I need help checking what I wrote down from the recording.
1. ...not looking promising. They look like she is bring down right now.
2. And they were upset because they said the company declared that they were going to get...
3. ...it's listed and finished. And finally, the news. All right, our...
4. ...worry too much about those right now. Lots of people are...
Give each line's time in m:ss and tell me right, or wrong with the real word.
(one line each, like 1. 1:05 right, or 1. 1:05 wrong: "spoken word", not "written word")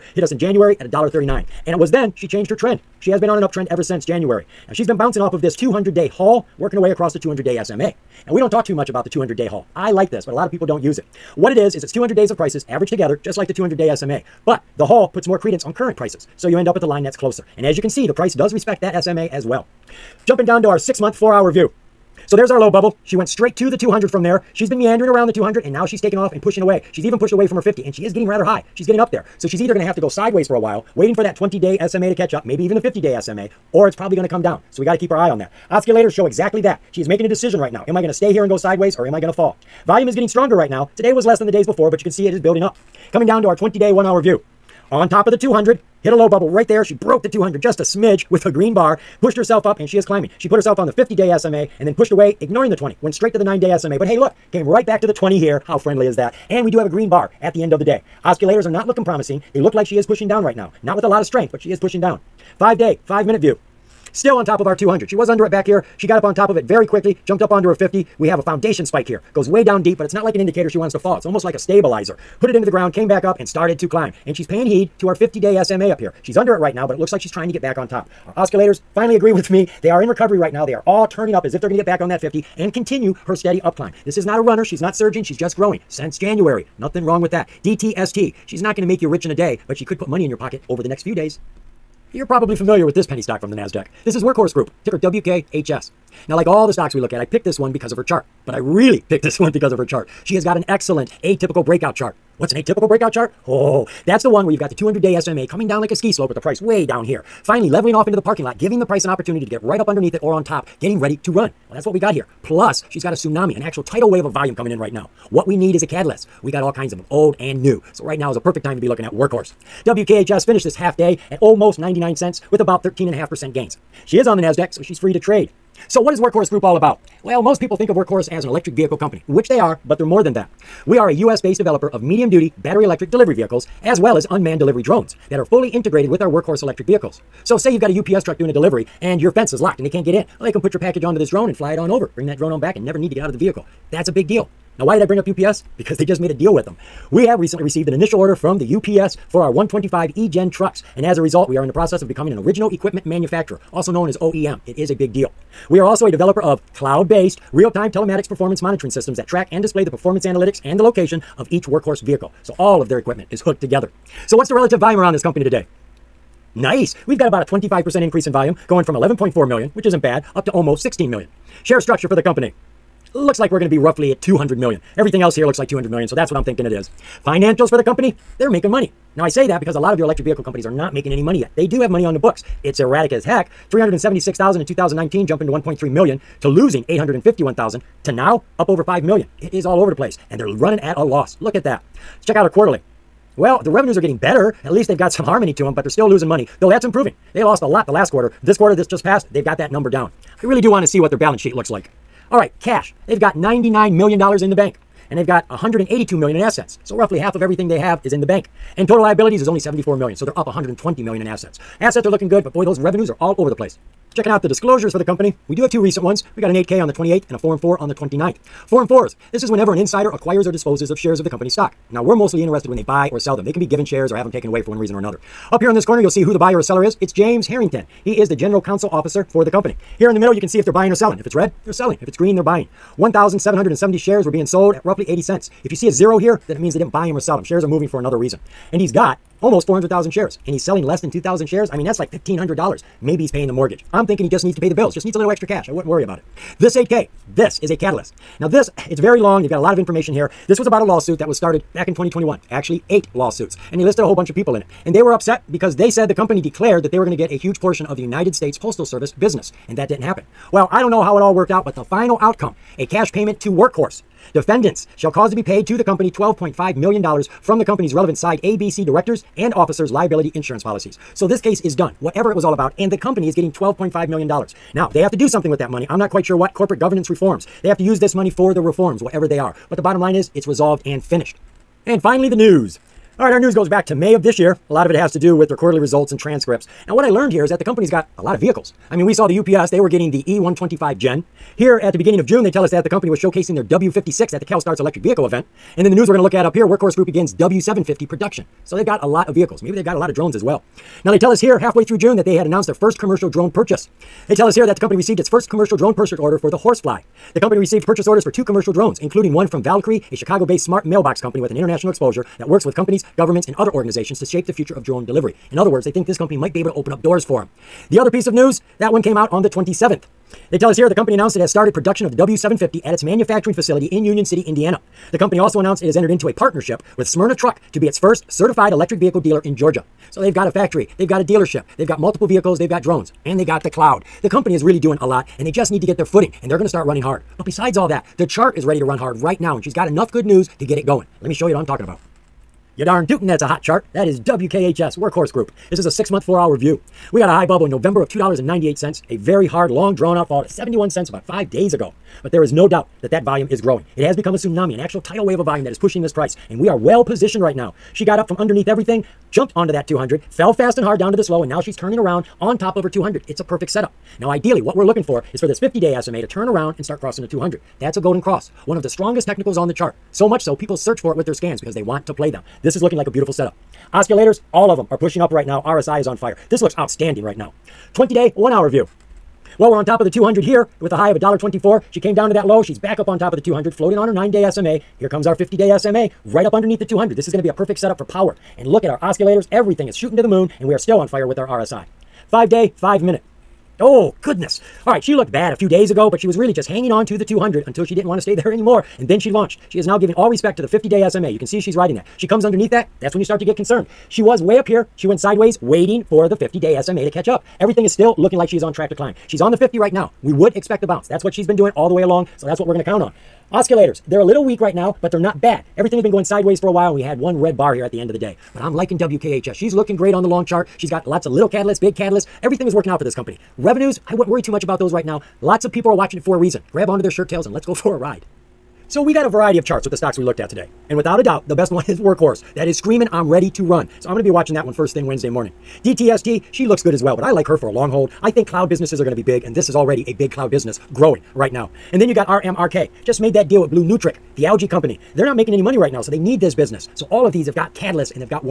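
1. 0:58 wrong: "pushing", not "bring"
2. 4:14 right
3. 4:40 wrong: "resolved", not "listed"
4. 7:04 right.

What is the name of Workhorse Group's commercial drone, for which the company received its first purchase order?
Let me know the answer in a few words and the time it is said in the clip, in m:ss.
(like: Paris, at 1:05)
Horsefly, at 5:06.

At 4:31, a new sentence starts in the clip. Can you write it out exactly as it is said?
So this case is done, whatever it was all about, and the company is getting $12.5 million.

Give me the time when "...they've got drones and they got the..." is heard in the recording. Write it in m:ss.
5:32.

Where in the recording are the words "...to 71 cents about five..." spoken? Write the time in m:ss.
5:50.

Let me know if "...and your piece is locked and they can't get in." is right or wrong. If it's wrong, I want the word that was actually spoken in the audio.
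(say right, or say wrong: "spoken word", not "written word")
wrong: "fence", not "piece".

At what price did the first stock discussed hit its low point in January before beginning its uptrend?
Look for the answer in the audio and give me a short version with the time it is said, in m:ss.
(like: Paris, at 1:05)
$1.39, at 0:00.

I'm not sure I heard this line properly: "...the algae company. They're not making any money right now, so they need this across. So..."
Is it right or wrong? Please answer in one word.
wrong.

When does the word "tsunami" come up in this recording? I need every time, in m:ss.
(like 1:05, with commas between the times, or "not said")
1:53, 5:54.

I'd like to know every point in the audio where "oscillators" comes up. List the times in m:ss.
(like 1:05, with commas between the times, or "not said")
0:35, 1:18, 6:13, 6:29, 6:53.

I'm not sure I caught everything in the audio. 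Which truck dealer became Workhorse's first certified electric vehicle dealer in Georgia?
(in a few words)
Smyrna Truck.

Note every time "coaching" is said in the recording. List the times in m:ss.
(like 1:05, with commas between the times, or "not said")
not said.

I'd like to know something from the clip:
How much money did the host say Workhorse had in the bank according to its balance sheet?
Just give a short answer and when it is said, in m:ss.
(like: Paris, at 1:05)
$99 million, at 3:23.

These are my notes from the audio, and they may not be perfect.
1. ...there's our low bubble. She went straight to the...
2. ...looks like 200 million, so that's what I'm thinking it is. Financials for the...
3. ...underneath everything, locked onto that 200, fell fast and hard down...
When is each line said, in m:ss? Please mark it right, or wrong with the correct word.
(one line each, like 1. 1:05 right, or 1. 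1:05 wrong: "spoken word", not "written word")
1. 0:22 right
2. 2:55 right
3. 5:58 wrong: "jumped", not "locked".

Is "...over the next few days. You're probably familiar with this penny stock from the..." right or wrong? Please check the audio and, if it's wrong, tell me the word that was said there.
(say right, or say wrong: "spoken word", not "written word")
right.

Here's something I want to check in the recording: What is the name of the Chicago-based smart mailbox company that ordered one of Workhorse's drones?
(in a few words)
Valqari.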